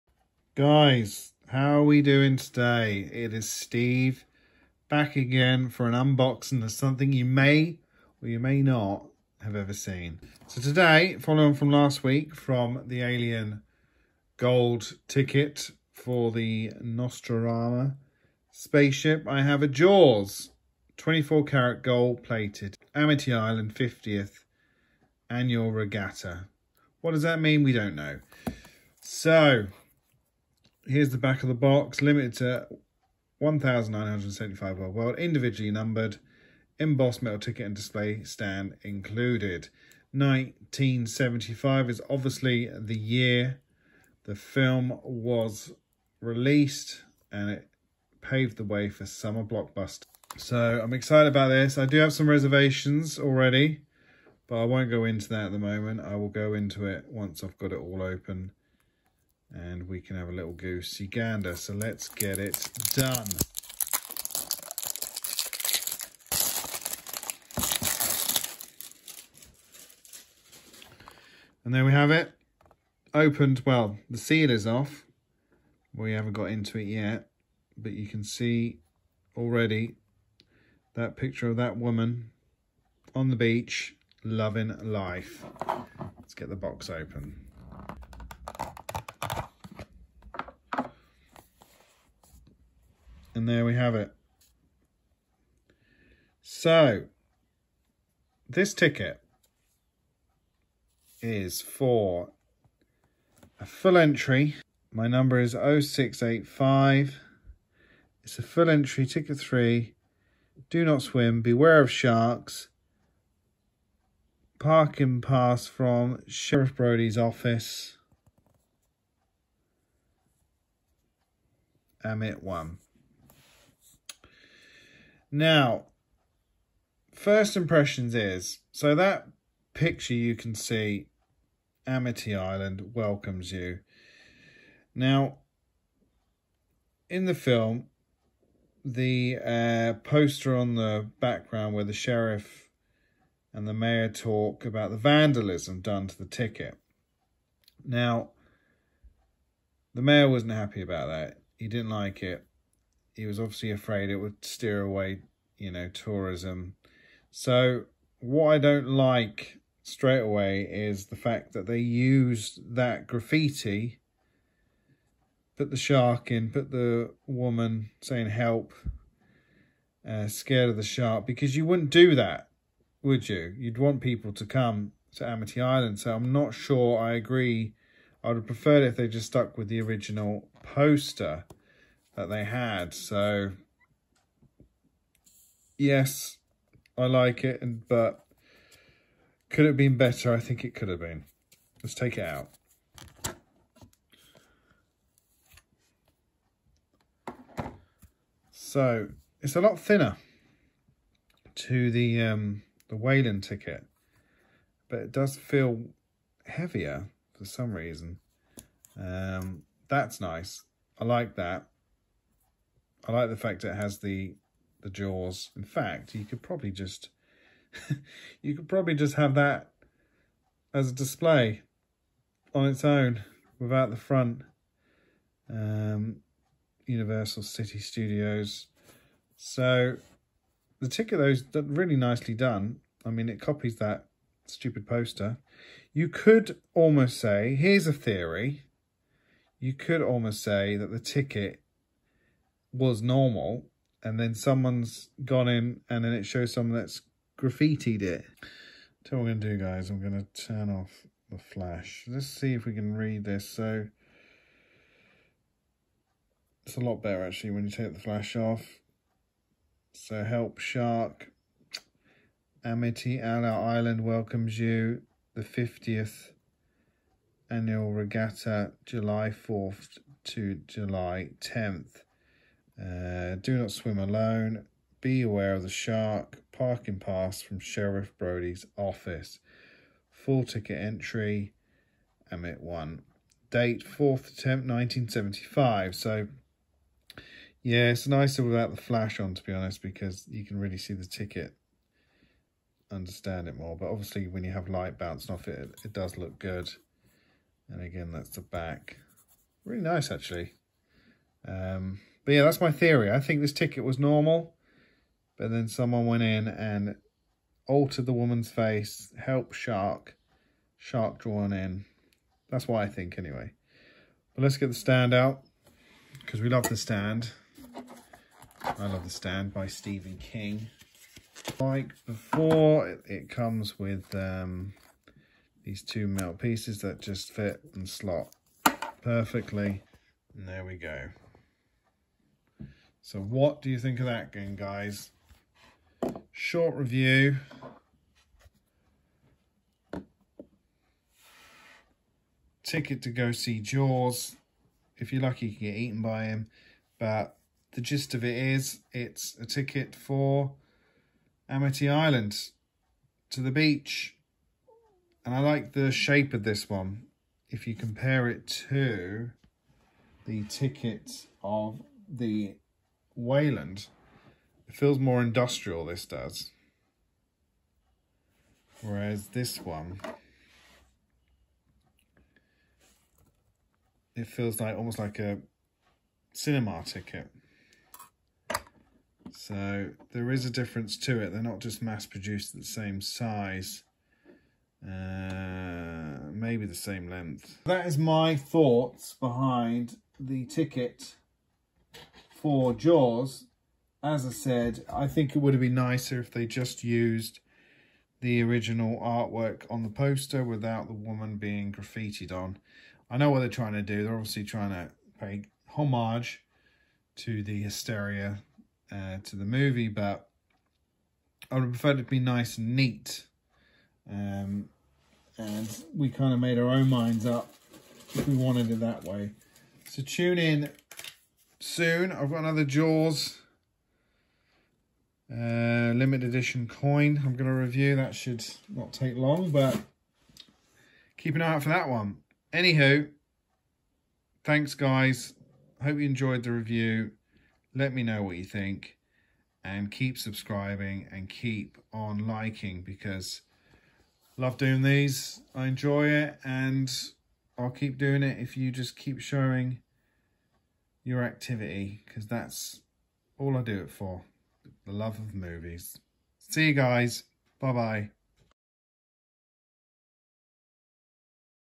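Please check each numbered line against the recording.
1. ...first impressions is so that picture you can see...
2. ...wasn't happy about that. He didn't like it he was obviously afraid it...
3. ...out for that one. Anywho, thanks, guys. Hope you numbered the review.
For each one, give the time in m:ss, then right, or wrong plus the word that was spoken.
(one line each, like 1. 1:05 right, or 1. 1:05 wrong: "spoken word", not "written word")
1. 2:07 right
2. 2:30 right
3. 7:11 wrong: "enjoyed", not "numbered".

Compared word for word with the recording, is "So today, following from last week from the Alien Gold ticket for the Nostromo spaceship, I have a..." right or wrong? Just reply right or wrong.
right.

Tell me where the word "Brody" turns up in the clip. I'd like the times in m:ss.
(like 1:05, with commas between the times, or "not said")
1:56, 4:38.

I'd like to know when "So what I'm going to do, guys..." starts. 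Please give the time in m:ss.
4:09.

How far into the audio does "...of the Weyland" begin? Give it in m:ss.
6:01.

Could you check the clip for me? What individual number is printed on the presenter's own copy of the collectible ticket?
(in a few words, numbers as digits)
0685.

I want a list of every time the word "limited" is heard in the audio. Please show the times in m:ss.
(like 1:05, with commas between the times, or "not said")
0:32, 7:05.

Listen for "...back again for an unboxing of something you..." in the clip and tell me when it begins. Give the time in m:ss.
0:04.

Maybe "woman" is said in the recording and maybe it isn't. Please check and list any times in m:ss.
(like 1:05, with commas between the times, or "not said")
1:21, 2:47, 5:08, 6:40.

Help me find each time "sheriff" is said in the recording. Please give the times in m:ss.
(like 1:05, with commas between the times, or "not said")
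1:56, 2:21, 4:37.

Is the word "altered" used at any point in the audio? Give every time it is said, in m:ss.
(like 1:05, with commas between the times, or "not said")
5:07.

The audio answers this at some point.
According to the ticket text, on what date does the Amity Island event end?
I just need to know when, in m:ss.
4:30.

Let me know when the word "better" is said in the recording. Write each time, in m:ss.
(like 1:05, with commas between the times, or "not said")
3:09, 4:17.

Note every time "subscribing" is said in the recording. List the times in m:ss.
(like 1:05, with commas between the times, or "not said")
7:20.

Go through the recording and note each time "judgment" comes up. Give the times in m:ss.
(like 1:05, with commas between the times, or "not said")
not said.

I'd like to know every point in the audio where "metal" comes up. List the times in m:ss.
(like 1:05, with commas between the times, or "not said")
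0:37, 5:26.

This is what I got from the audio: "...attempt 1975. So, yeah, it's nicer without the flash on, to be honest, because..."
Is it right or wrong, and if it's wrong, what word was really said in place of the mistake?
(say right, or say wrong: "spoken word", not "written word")
right.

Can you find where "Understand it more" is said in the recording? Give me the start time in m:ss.
4:52.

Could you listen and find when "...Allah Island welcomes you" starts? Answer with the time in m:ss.
4:23.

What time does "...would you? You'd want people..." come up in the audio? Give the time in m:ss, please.
2:53.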